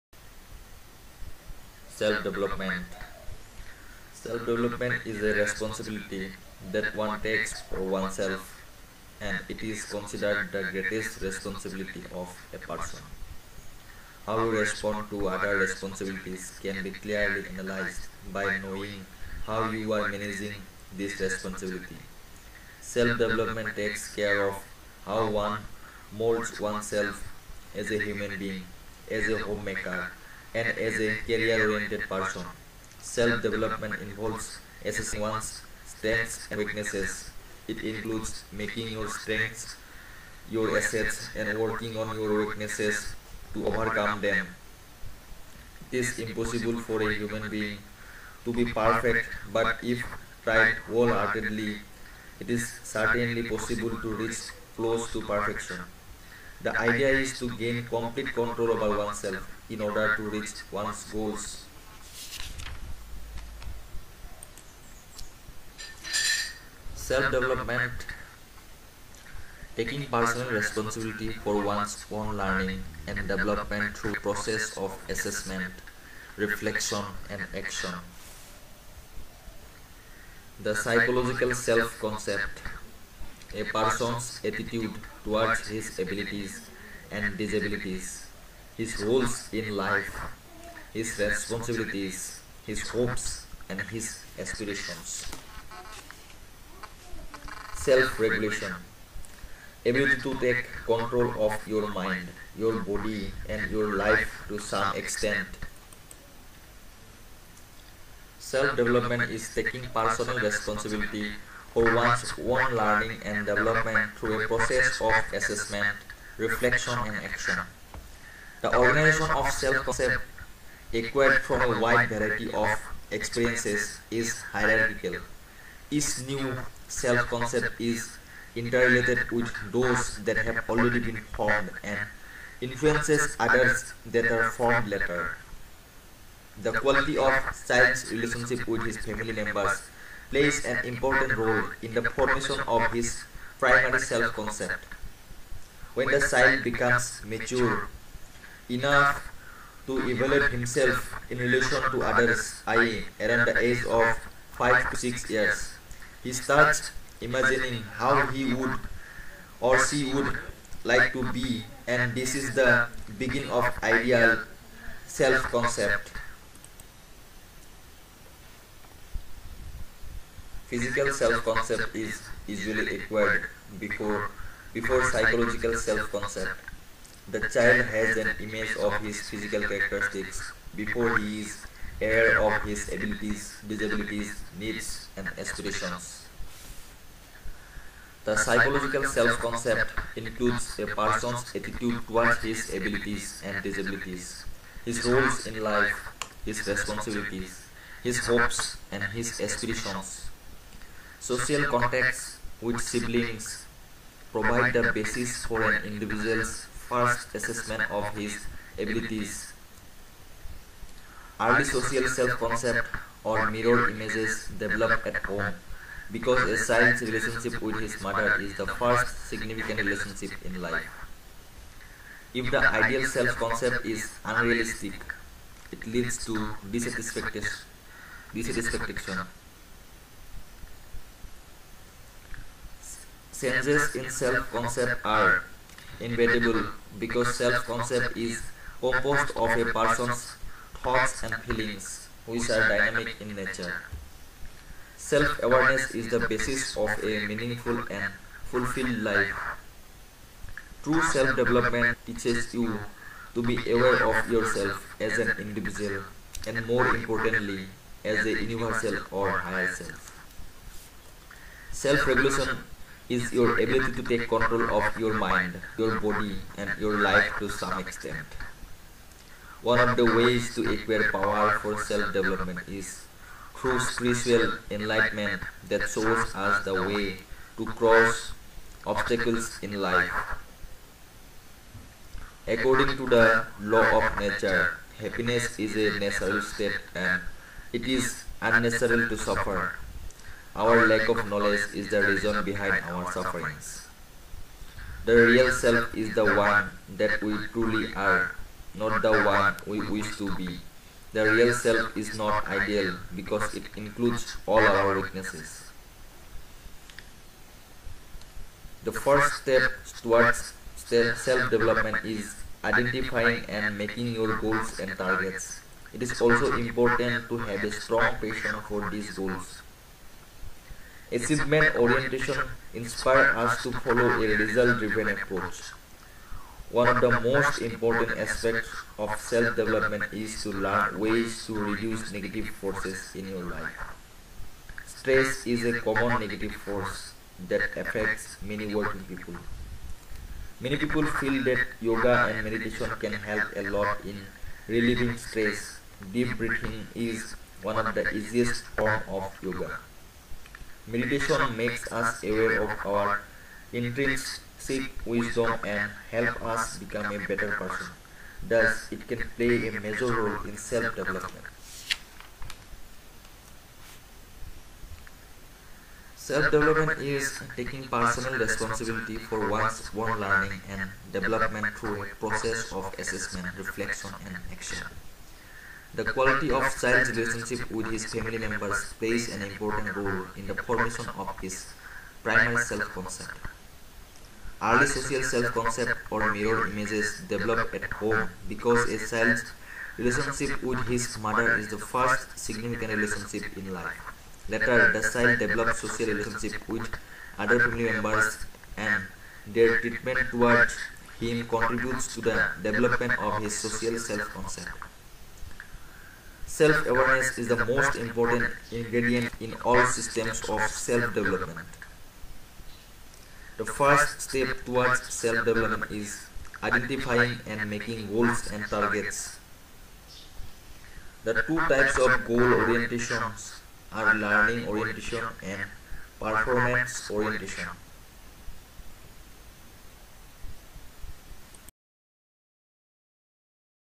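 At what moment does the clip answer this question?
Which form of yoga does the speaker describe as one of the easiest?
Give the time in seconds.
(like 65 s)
346 s.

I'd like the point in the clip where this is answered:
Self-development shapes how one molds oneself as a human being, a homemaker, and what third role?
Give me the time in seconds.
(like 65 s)
31 s.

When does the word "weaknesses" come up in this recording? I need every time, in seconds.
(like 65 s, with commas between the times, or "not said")
36 s, 42 s, 304 s.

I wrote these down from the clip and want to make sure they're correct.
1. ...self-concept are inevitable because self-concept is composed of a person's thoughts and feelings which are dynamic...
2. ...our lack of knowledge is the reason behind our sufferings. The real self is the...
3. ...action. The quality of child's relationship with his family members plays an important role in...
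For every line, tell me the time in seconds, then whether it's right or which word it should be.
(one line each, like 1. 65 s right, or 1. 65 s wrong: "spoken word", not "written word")
1. 234 s right
2. 290 s right
3. 374 s right.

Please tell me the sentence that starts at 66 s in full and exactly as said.
Self-development Taking personal responsibility for one's own learning and development through process of assessment, reflection and action.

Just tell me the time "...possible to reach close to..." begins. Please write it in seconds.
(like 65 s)
53 s.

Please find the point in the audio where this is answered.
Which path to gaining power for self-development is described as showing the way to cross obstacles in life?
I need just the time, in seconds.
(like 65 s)
273 s.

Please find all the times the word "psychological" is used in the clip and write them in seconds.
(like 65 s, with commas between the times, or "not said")
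80 s, 175 s, 188 s.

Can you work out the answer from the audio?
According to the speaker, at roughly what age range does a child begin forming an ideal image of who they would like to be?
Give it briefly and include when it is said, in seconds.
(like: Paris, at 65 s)
5 to 6 years, at 154 s.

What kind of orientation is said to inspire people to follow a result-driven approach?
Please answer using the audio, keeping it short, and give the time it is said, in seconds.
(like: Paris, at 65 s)
Achievement orientation, at 321 s.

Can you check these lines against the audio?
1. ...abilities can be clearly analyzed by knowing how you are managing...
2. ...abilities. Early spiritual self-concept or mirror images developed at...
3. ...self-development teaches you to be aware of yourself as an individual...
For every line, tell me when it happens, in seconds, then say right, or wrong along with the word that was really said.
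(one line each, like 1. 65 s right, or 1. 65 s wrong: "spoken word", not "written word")
1. 15 s wrong: "responsibilities", not "abilities"
2. 208 s wrong: "social", not "spiritual"
3. 251 s right.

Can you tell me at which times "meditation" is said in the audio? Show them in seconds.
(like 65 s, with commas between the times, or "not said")
342 s, 350 s.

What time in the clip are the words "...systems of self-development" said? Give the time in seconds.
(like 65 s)
409 s.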